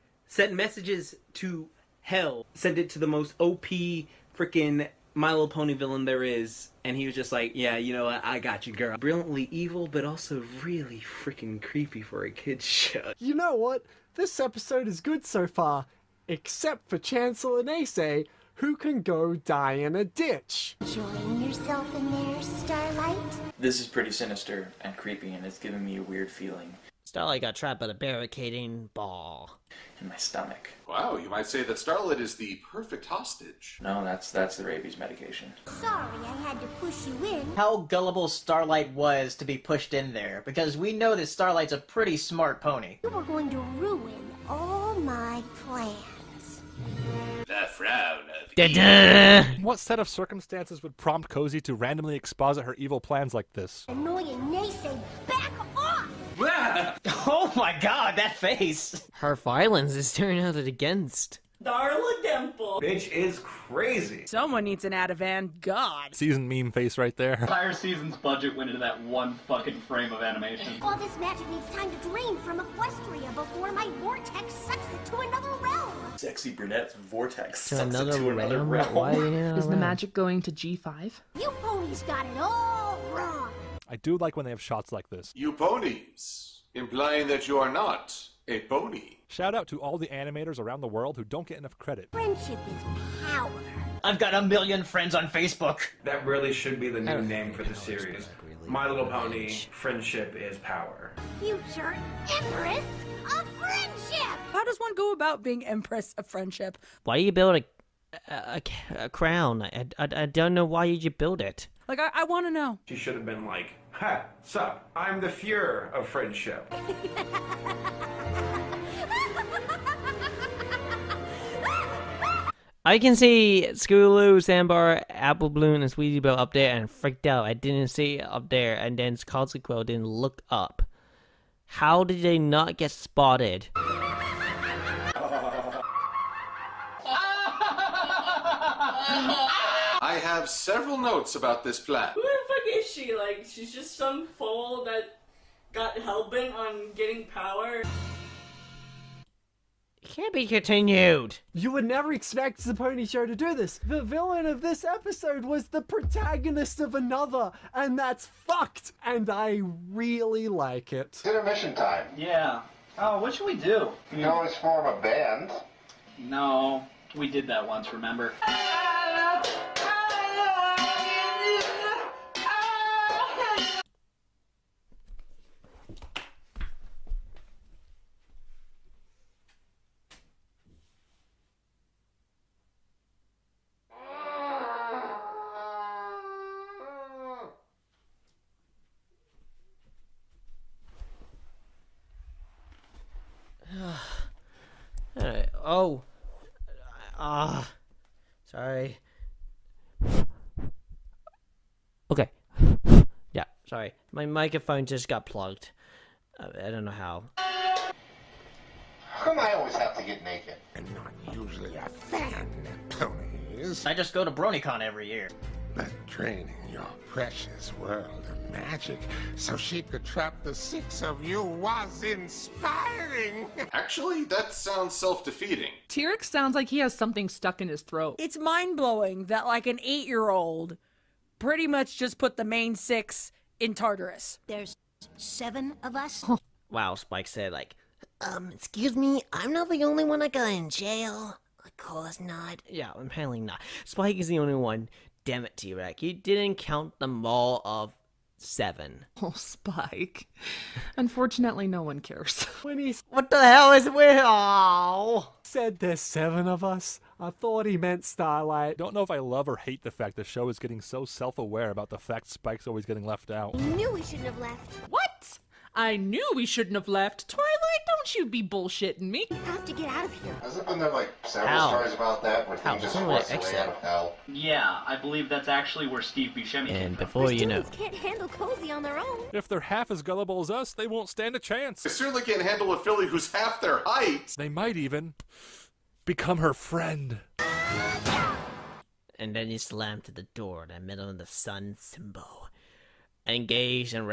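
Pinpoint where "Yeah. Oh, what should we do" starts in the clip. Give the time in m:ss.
2:42.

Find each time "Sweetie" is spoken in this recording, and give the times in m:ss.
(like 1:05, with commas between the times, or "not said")
2:05.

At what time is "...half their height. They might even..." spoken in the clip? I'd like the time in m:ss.
4:43.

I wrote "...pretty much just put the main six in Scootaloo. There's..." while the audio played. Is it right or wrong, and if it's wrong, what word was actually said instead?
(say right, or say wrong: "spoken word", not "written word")
wrong: "Tartarus", not "Scootaloo".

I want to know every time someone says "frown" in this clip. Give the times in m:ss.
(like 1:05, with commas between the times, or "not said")
0:47.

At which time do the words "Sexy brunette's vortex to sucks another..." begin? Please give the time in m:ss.
1:16.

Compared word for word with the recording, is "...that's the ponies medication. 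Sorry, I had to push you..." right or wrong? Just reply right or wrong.
wrong.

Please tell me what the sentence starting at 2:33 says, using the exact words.
The villain of this episode was the protagonist of another, and that's fucked.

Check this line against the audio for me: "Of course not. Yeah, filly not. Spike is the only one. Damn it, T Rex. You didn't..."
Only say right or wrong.
wrong.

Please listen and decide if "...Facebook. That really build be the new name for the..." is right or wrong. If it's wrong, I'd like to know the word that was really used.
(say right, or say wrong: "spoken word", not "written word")
wrong: "should", not "build".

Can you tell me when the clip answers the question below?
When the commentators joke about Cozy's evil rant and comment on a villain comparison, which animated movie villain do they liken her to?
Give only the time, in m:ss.
1:01.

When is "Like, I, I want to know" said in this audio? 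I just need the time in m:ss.
1:51.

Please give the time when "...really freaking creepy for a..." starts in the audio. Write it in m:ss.
0:10.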